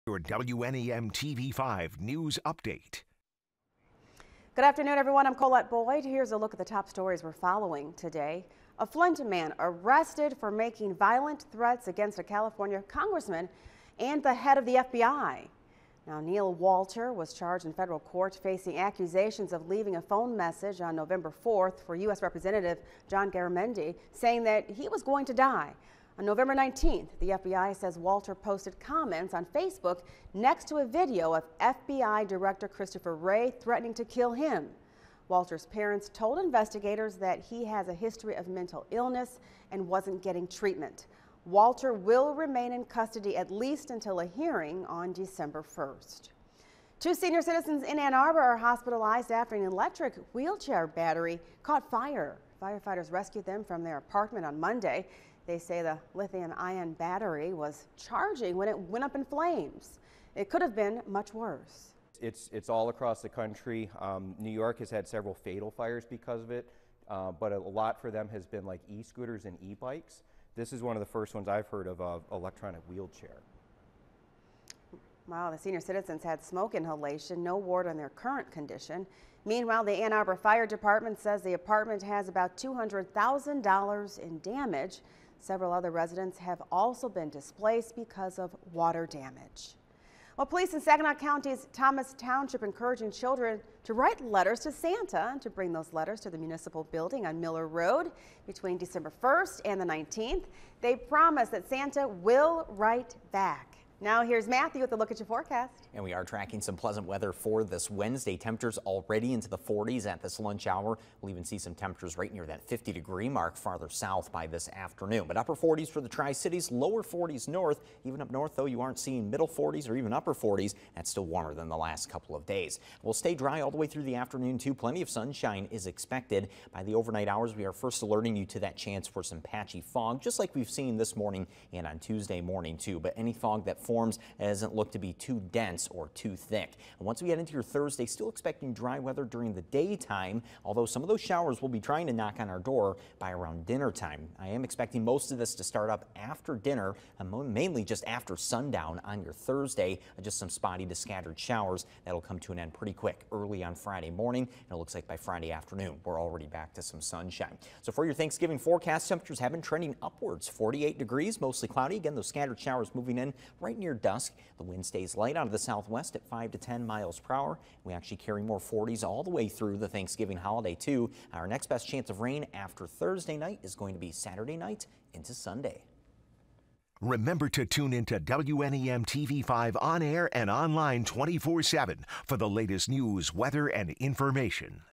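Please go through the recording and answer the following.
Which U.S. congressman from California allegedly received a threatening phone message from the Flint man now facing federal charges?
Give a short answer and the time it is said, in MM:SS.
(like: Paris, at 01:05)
John Garamendi, at 00:23.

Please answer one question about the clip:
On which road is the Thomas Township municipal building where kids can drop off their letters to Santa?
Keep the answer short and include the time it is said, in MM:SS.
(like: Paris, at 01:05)
Miller Road, at 01:37.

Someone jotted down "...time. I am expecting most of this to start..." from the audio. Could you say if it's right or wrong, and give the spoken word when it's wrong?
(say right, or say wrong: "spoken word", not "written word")
right.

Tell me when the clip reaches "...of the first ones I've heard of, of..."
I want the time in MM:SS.
01:10.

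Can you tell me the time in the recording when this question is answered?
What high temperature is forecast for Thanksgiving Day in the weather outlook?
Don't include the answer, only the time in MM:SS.
02:40.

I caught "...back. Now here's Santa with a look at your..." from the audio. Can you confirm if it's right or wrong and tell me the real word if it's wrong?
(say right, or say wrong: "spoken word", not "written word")
wrong: "Matthew", not "Santa".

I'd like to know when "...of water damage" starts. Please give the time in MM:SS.
01:28.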